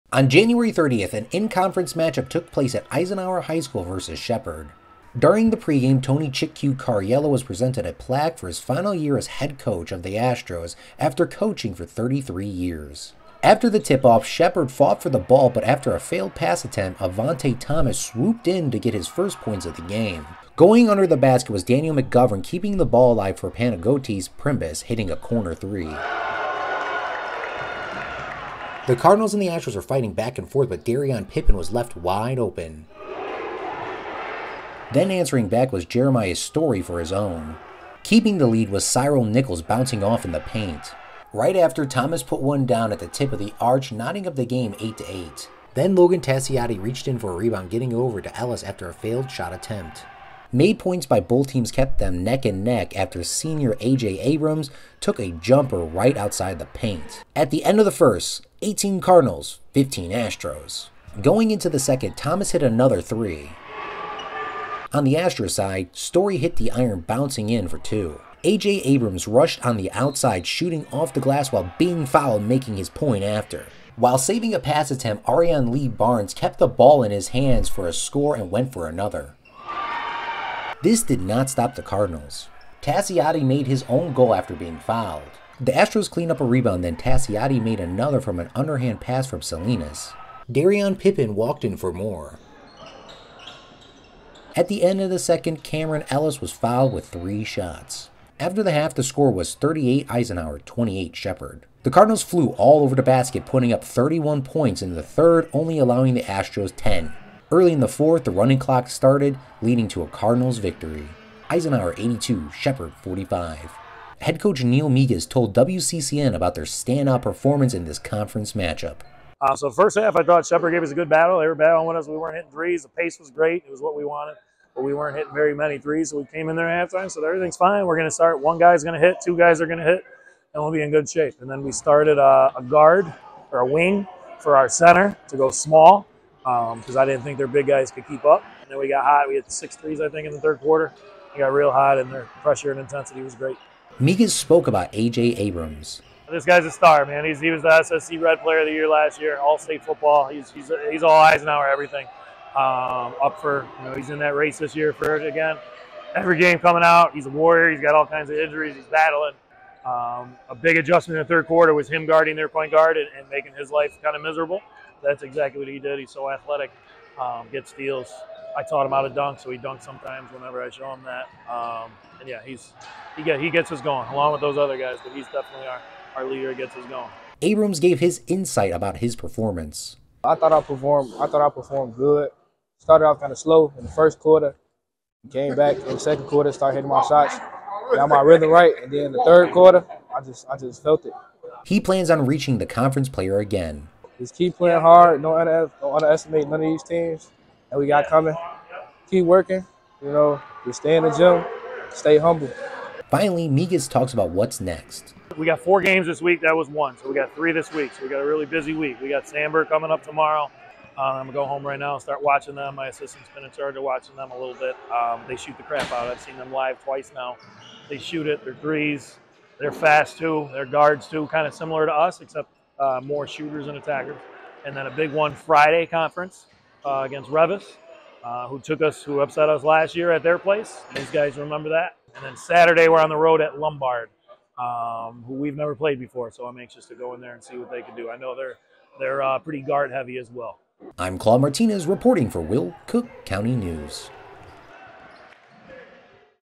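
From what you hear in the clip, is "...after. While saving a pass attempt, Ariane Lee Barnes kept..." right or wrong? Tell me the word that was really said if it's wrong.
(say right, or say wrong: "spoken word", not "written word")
right.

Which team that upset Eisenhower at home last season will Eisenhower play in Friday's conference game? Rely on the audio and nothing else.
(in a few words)
Reavis.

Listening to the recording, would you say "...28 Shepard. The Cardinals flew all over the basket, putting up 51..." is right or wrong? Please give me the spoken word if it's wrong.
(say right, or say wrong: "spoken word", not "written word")
wrong: "31", not "51".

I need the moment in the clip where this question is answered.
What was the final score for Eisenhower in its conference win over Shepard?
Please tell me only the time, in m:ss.
1:51.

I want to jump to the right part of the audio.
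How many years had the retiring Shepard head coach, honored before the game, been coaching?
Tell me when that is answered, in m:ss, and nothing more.
0:11.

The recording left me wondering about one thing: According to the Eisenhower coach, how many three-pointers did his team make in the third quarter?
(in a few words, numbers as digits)
6.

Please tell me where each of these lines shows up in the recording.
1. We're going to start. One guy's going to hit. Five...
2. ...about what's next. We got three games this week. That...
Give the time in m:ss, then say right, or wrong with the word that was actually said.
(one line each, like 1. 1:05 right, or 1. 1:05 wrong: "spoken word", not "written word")
1. 2:07 wrong: "Two", not "Five"
2. 3:24 wrong: "four", not "three".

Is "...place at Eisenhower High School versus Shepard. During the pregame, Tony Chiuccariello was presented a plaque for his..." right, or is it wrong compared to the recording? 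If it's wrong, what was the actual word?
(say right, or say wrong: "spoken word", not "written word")
right.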